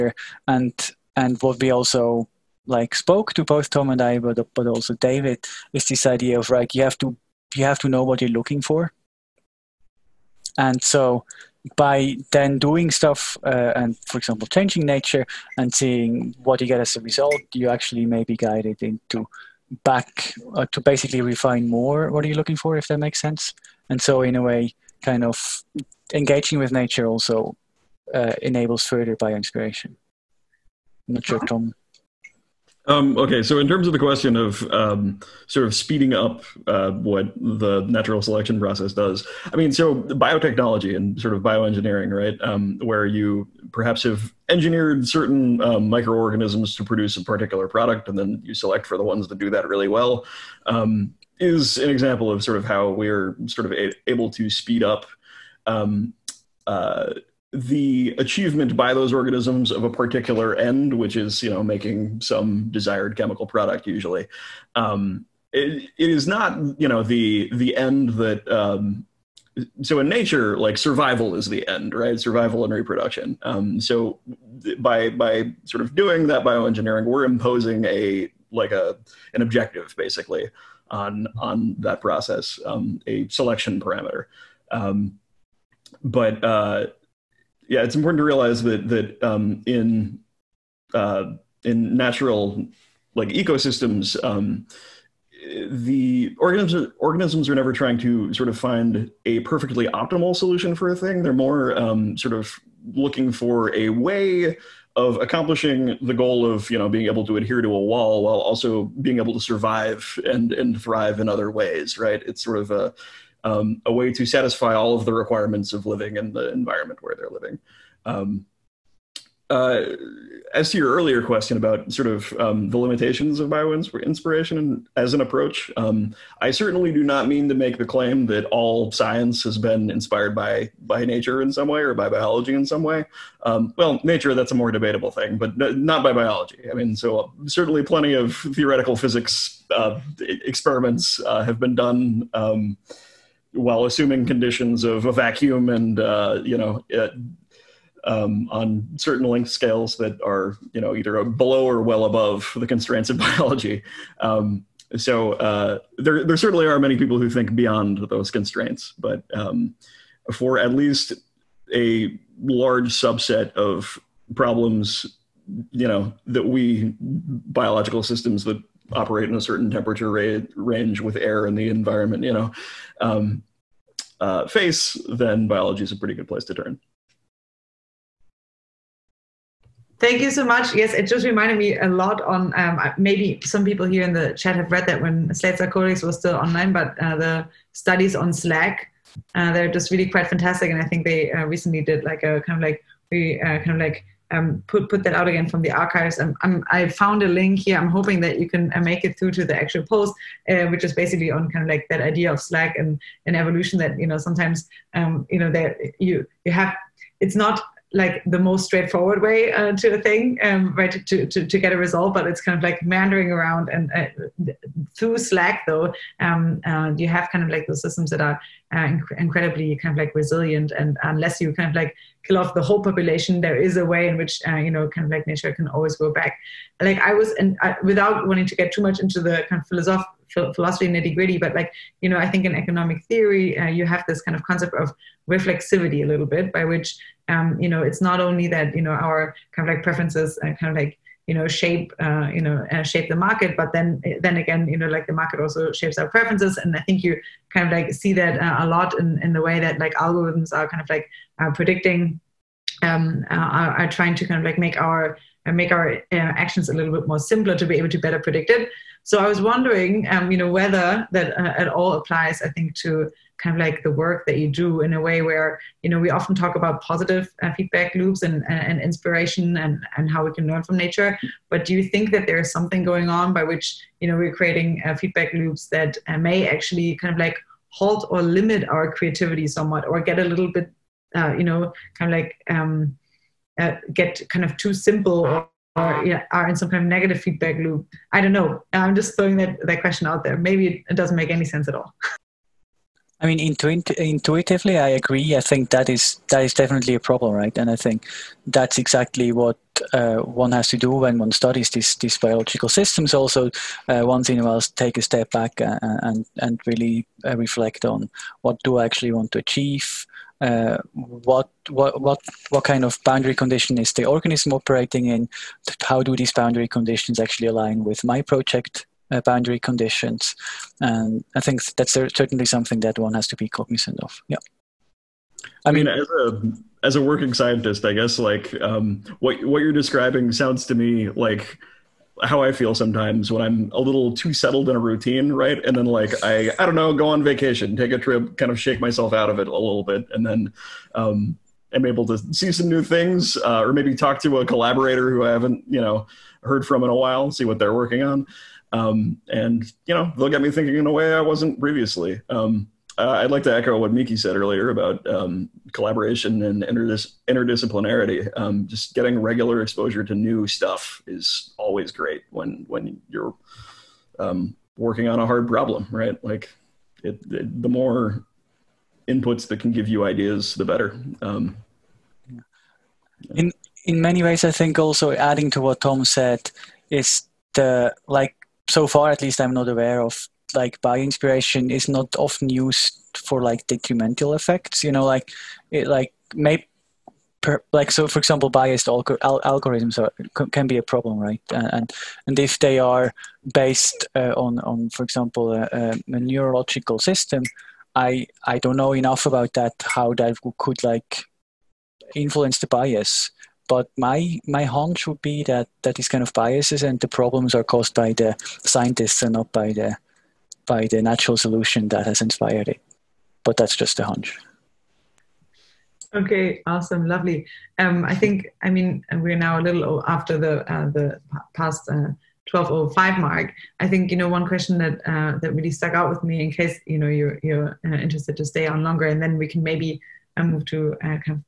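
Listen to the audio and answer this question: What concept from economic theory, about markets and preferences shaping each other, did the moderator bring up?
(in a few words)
reflexivity.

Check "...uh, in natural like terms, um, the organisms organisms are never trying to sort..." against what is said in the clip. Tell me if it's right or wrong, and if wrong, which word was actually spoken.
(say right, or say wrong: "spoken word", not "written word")
wrong: "ecosystems", not "terms".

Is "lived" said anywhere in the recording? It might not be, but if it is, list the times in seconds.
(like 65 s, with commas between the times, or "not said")
not said.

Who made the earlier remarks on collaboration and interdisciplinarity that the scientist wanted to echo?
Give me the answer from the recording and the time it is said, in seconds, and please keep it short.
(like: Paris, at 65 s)
Miki, at 353 s.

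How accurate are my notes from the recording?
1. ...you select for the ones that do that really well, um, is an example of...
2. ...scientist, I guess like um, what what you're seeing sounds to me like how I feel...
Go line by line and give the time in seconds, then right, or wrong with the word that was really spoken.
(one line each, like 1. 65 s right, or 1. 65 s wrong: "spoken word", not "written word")
1. 48 s right
2. 327 s wrong: "describing", not "seeing".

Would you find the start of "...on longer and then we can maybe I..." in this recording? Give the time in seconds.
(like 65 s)
428 s.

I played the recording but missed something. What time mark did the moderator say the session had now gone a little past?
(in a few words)
12:05.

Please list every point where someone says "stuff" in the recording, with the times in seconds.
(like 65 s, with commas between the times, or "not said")
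12 s, 360 s.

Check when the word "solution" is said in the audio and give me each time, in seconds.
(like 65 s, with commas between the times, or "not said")
100 s, 411 s.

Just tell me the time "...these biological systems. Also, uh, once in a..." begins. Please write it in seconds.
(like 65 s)
301 s.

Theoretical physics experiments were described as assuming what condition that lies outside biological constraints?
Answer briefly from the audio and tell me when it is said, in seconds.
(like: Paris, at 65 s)
a vacuum, at 145 s.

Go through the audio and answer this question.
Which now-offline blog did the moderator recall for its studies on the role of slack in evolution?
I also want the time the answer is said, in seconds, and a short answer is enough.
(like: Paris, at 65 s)
Slate Star Codex, at 185 s.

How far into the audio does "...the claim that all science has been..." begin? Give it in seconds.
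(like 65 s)
127 s.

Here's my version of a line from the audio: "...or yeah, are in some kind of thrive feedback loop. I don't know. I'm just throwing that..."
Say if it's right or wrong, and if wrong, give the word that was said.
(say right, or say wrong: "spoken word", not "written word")
wrong: "negative", not "thrive".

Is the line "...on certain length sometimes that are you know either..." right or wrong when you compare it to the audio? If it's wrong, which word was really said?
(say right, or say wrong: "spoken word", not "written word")
wrong: "scales", not "sometimes".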